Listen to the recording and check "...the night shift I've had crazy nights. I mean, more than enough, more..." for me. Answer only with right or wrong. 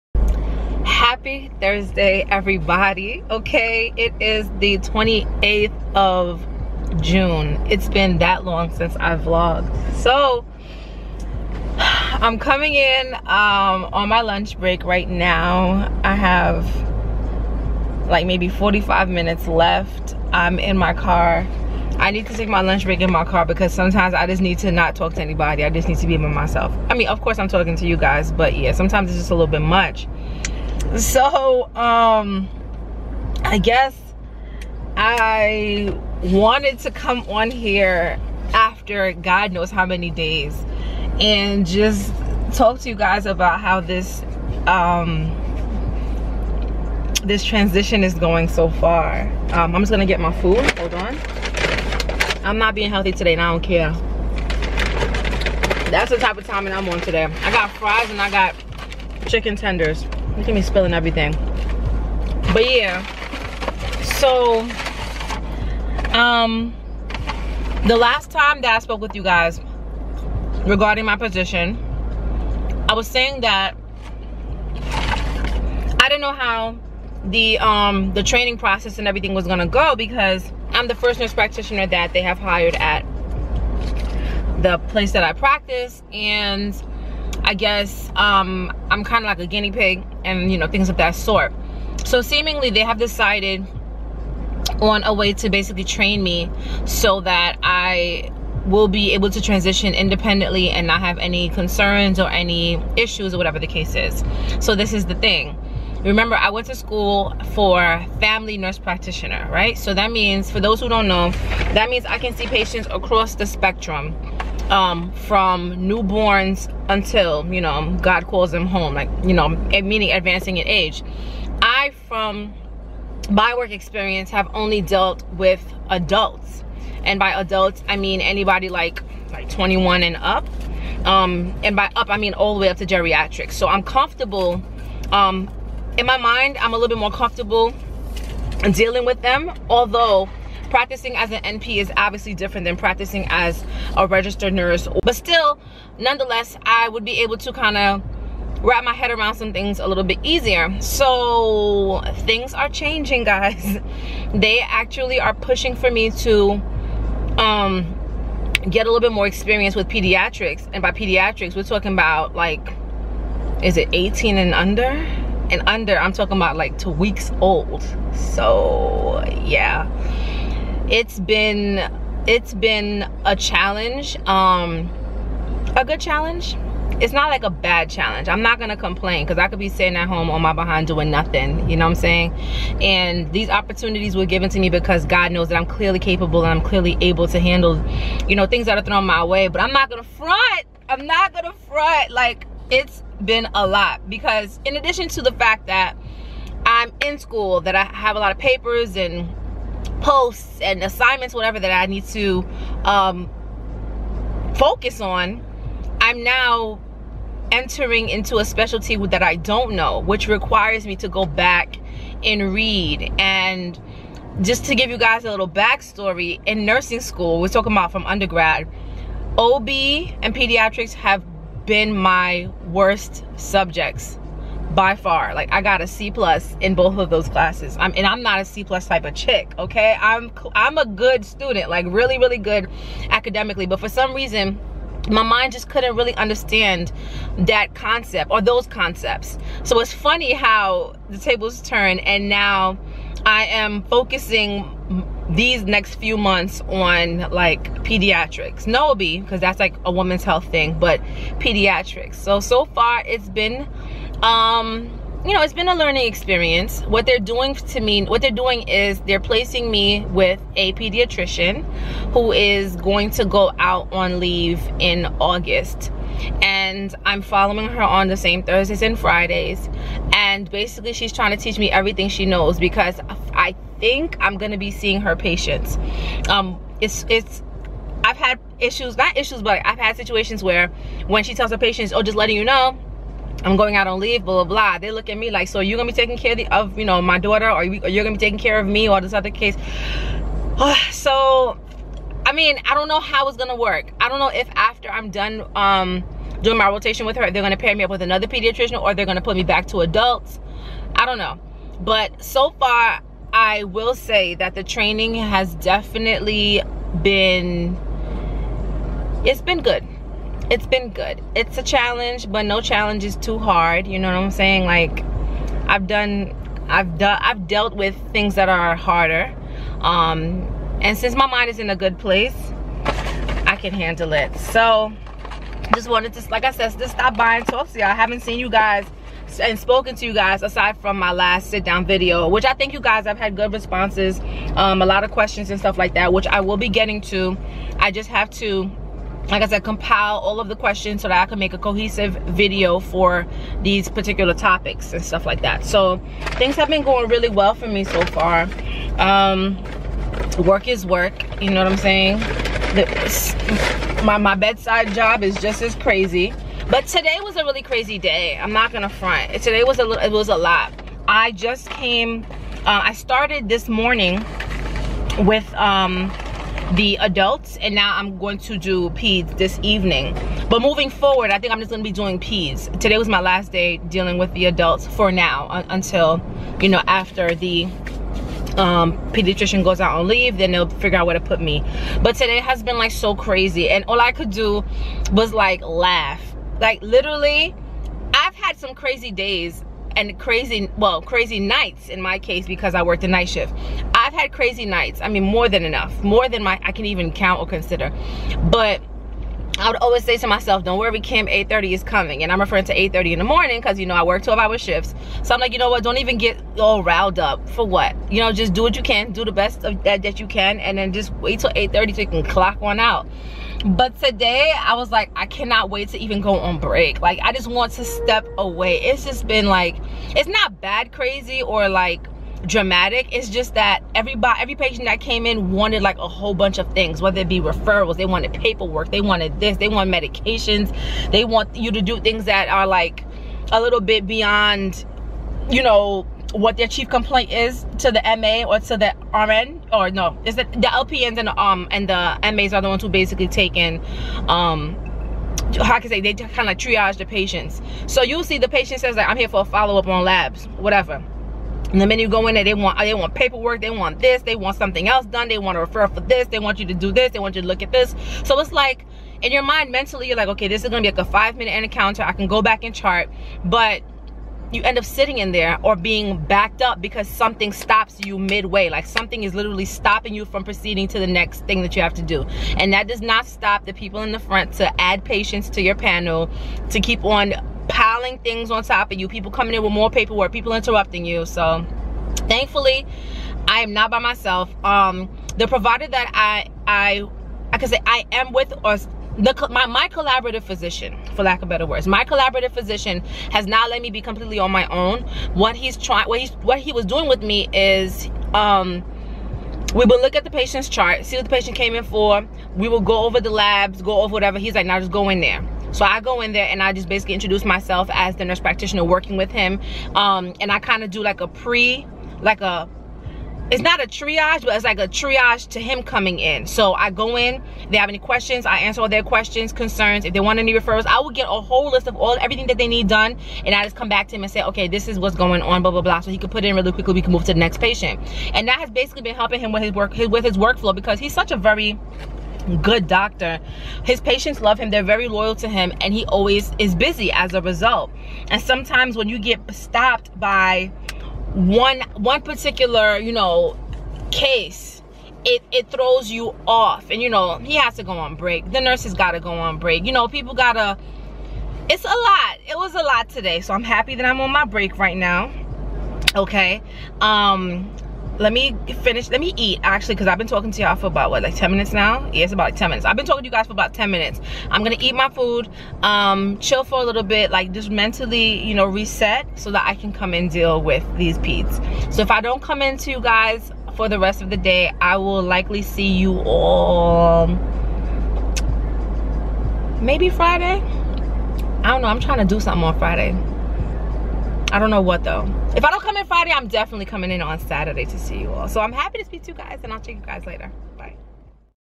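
right.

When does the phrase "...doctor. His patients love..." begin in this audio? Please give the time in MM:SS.
08:52.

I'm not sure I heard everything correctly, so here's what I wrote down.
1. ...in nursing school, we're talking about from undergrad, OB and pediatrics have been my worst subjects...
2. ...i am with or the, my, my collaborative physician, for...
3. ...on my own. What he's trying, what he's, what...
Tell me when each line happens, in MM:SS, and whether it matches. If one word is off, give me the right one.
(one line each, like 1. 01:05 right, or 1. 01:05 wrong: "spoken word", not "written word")
1. 03:36 right
2. 08:07 right
3. 08:14 right.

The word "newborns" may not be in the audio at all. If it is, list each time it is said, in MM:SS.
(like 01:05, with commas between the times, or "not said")
01:55.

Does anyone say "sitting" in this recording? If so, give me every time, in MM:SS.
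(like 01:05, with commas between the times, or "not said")
02:59, 07:44.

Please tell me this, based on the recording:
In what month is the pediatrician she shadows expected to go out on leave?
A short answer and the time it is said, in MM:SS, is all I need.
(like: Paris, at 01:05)
August, at 04:25.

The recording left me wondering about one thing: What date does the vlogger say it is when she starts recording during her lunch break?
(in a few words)
28th of June.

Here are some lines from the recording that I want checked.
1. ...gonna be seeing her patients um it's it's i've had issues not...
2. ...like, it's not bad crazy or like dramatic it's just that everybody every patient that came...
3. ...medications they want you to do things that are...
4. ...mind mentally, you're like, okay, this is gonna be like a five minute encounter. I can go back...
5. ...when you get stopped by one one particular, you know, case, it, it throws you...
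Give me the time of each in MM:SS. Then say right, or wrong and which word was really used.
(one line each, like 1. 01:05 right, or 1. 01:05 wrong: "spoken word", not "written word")
1. 04:34 right
2. 06:59 right
3. 07:09 right
4. 07:39 right
5. 08:58 right.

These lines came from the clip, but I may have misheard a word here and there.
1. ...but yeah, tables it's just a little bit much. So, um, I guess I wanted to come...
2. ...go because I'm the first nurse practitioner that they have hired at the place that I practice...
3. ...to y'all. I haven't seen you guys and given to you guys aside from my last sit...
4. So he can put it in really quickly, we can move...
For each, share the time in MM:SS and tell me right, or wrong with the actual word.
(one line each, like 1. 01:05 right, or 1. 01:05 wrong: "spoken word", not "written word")
1. 00:28 wrong: "sometimes", not "tables"
2. 01:19 right
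3. 05:27 wrong: "spoken", not "given"
4. 08:45 right.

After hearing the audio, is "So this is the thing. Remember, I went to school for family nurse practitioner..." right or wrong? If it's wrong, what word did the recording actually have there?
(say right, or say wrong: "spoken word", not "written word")
right.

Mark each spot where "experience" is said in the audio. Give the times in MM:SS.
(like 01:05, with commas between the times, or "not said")
02:03, 02:39, 04:16.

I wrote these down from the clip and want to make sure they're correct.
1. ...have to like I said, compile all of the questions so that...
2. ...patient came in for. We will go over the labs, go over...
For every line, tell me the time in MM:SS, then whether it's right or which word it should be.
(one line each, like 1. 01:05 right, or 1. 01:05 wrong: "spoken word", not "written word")
1. 05:38 right
2. 08:21 right.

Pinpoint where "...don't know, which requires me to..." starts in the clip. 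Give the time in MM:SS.
03:29.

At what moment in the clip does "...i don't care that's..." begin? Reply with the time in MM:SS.
00:53.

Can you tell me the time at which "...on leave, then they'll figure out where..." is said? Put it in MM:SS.
06:19.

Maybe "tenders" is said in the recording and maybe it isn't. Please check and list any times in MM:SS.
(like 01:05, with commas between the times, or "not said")
00:59.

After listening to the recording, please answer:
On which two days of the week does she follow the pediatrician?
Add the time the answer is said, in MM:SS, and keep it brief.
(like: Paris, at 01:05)
Thursdays and Fridays, at 04:28.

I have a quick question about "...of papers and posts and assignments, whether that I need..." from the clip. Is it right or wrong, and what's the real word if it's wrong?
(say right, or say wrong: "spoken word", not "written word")
wrong: "whatever", not "whether".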